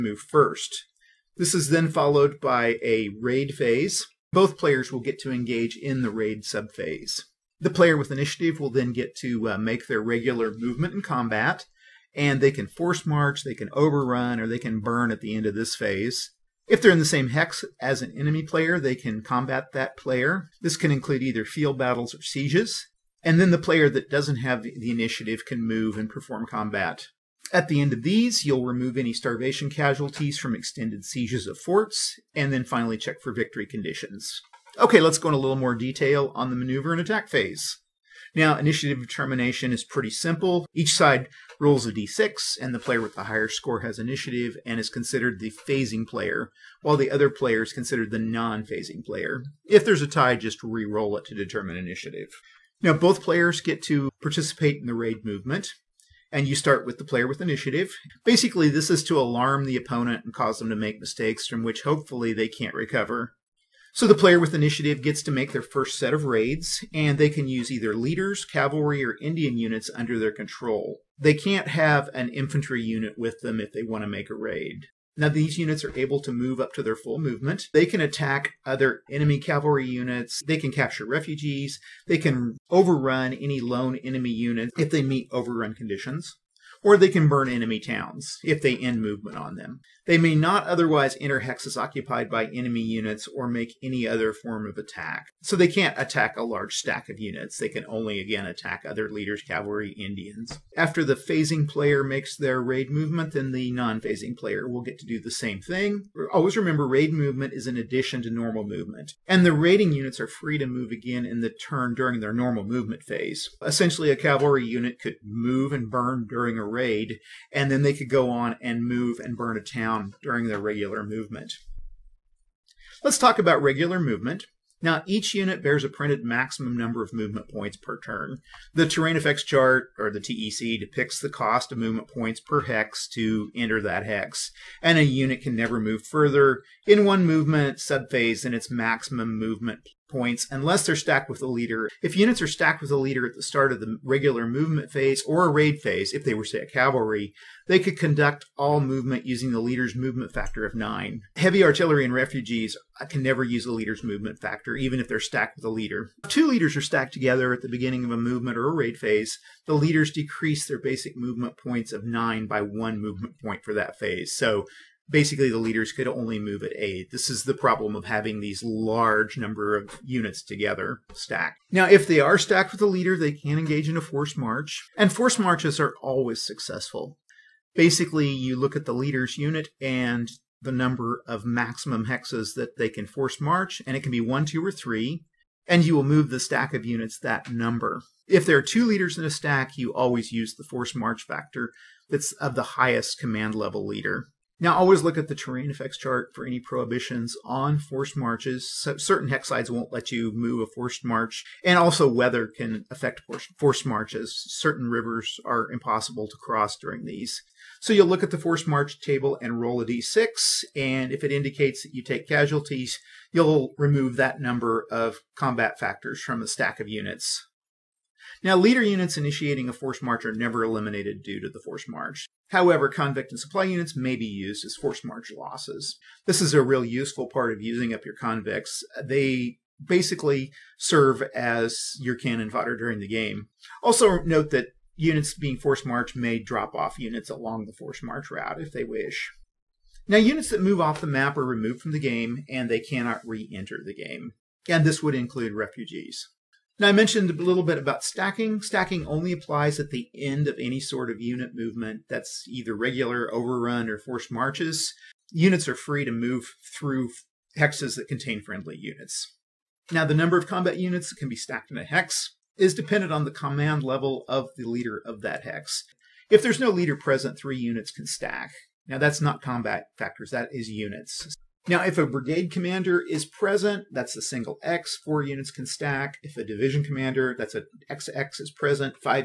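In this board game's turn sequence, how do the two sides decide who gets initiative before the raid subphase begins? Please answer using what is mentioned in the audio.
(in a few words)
Each rolls a d6.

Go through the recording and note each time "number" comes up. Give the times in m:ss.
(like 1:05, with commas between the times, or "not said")
2:06, 2:49, 3:00, 3:07, 3:34, 4:20.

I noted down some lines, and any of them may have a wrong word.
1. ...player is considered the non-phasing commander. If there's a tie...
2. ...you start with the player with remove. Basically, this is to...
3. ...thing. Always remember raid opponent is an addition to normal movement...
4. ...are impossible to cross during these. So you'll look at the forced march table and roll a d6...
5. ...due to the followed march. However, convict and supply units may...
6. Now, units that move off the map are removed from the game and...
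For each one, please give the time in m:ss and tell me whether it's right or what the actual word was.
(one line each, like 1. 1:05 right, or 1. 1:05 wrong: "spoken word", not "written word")
1. 0:47 wrong: "player", not "commander"
2. 0:56 wrong: "initiative", not "remove"
3. 1:45 wrong: "movement", not "opponent"
4. 3:25 right
5. 3:41 wrong: "forced", not "followed"
6. 4:00 right.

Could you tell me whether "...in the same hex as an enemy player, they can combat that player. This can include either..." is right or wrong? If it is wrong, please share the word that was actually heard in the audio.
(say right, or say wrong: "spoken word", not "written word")
right.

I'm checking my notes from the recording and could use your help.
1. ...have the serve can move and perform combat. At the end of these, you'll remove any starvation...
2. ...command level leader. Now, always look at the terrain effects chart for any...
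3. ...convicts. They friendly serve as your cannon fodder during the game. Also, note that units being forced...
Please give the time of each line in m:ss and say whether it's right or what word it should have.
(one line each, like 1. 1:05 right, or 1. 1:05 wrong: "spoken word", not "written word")
1. 0:24 wrong: "initiative", not "serve"
2. 3:13 right
3. 3:48 wrong: "basically", not "friendly".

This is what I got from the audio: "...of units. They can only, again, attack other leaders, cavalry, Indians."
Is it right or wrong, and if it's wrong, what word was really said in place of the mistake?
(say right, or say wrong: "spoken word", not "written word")
right.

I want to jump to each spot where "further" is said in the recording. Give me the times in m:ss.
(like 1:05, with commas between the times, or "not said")
2:16.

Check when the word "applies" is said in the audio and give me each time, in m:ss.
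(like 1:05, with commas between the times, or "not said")
4:09.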